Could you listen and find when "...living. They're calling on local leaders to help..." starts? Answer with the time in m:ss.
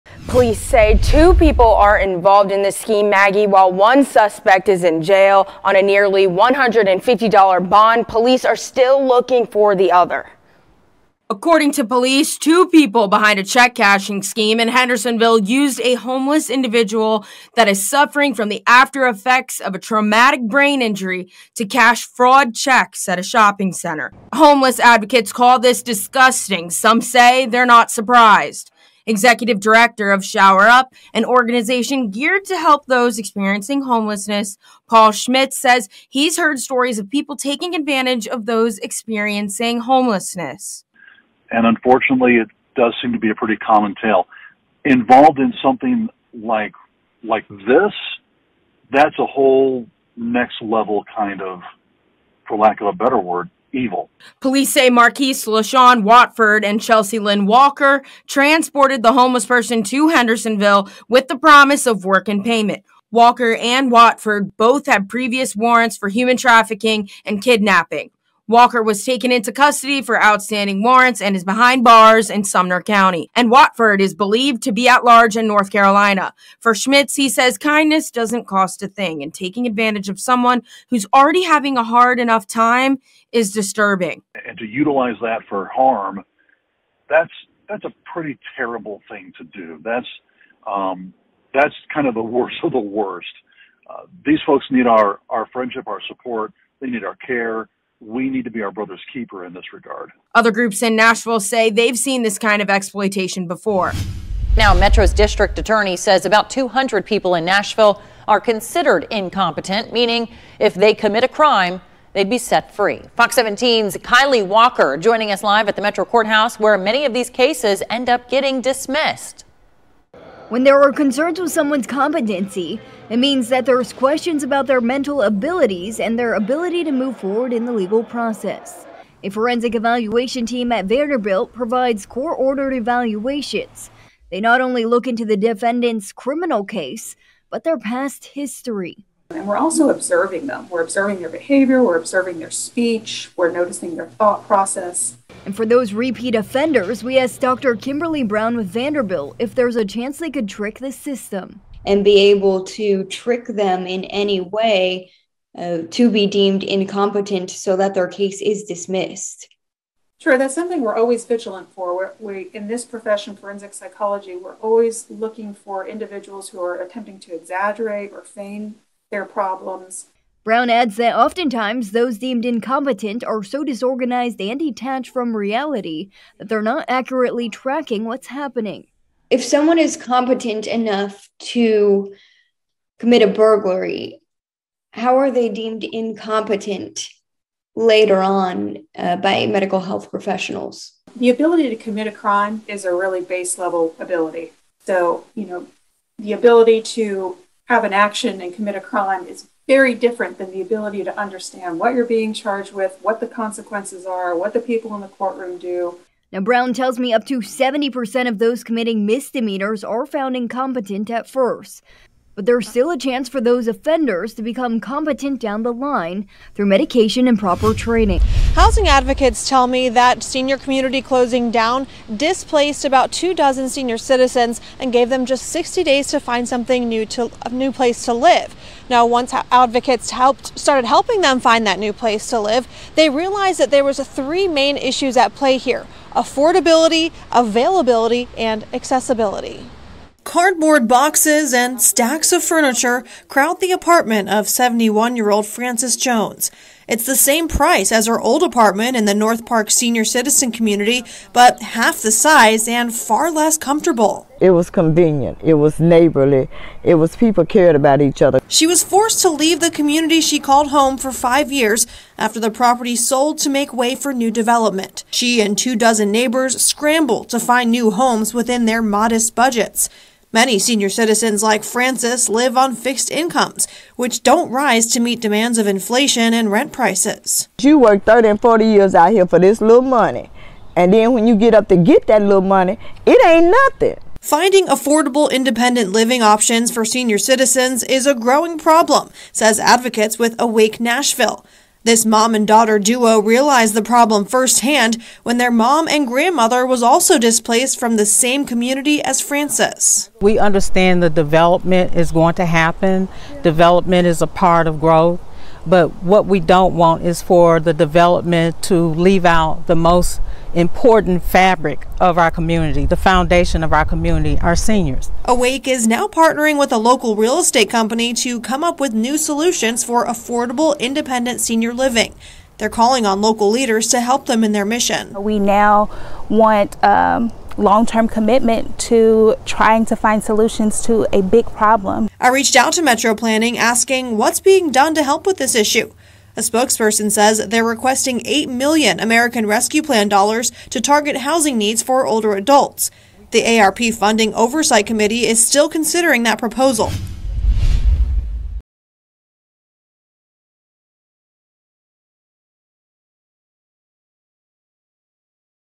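5:21.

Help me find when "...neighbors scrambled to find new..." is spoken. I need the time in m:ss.
4:26.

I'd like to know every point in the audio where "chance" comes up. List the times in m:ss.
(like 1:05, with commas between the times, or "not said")
2:29, 3:32.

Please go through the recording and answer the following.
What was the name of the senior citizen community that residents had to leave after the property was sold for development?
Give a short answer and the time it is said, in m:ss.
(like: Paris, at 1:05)
North Park, at 4:09.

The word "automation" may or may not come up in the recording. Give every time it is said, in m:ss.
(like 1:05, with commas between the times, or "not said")
not said.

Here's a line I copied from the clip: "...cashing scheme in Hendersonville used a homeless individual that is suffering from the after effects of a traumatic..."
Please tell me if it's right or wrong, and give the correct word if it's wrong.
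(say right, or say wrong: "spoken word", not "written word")
right.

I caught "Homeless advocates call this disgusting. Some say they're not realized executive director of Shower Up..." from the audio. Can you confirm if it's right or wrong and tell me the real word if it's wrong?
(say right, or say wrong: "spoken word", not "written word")
wrong: "surprised", not "realized".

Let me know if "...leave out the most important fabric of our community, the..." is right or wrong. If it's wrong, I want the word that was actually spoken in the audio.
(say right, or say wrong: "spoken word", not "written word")
right.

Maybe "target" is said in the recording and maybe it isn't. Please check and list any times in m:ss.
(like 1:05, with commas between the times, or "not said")
5:40.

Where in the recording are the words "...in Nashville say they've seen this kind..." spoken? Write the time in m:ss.
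1:40.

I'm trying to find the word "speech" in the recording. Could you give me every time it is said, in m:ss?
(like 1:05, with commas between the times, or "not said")
2:22.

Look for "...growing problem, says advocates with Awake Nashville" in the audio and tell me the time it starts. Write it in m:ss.
4:48.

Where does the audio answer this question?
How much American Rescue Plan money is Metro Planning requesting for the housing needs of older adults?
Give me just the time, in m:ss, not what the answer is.
5:38.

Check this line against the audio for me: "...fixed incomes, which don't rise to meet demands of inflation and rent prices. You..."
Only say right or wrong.
right.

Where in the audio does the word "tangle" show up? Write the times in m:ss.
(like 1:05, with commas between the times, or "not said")
not said.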